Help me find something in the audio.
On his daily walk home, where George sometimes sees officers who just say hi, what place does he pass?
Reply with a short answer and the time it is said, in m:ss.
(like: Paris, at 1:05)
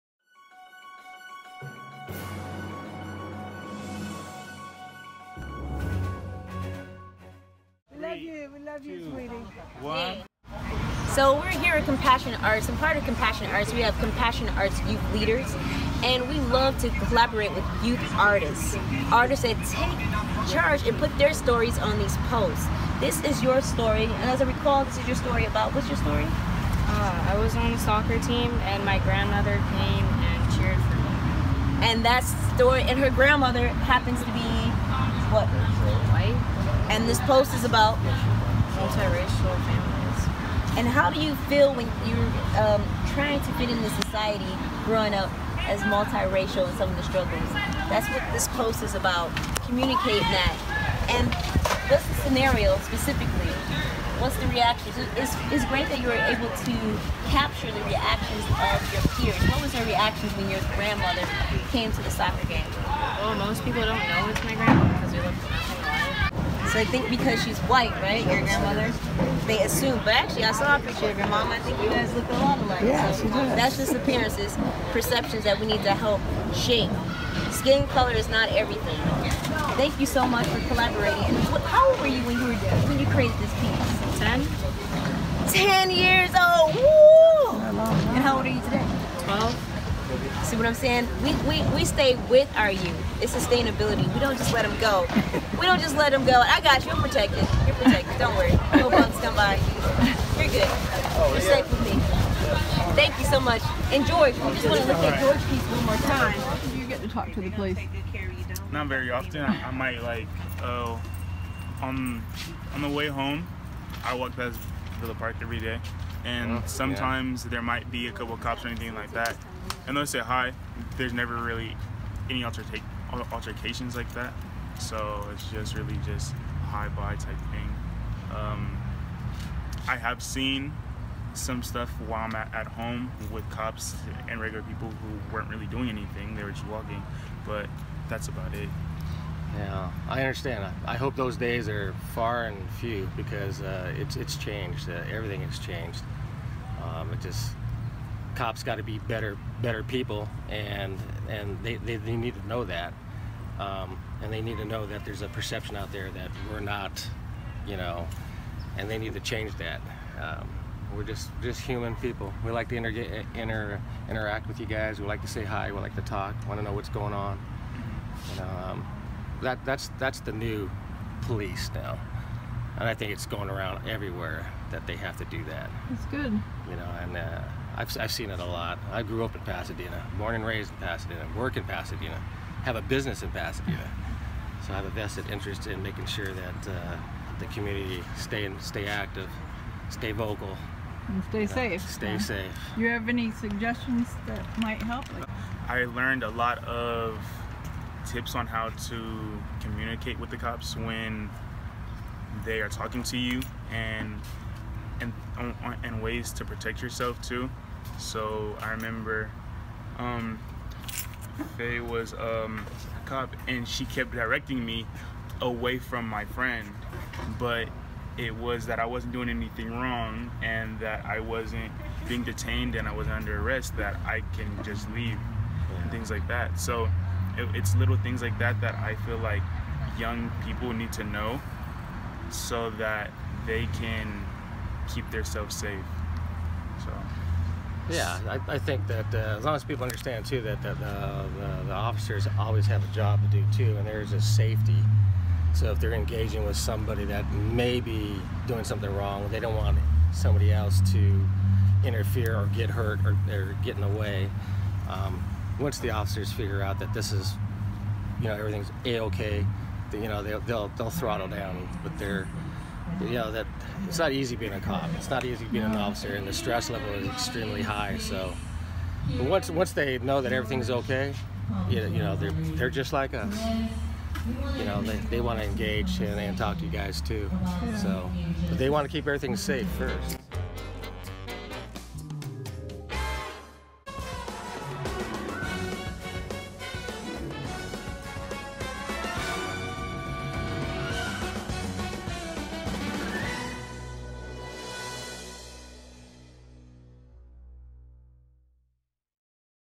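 Villa Park, at 1:54.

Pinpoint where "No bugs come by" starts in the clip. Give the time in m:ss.
1:38.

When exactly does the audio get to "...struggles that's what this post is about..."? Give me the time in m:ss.
0:47.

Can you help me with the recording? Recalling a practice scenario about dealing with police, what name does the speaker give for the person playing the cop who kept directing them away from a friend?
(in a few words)
Faye.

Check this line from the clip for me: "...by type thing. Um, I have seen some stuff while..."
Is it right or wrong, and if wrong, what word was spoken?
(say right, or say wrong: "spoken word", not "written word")
right.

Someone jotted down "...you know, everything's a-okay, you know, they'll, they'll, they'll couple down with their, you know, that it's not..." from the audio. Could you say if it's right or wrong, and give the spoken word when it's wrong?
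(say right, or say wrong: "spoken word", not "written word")
wrong: "throttle", not "couple".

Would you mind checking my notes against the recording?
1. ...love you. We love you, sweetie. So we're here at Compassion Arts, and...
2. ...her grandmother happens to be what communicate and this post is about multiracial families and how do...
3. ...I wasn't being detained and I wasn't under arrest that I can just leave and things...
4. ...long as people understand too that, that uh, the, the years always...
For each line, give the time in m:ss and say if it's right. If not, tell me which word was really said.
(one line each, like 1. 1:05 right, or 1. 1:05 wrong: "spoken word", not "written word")
1. 0:07 right
2. 0:32 wrong: "white", not "communicate"
3. 3:41 right
4. 3:59 wrong: "officers", not "years".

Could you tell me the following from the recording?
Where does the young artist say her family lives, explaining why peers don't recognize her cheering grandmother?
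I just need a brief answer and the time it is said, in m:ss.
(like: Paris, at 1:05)
Hawaii, at 1:05.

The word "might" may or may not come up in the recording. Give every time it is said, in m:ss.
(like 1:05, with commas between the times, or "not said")
1:49, 1:57, 3:14.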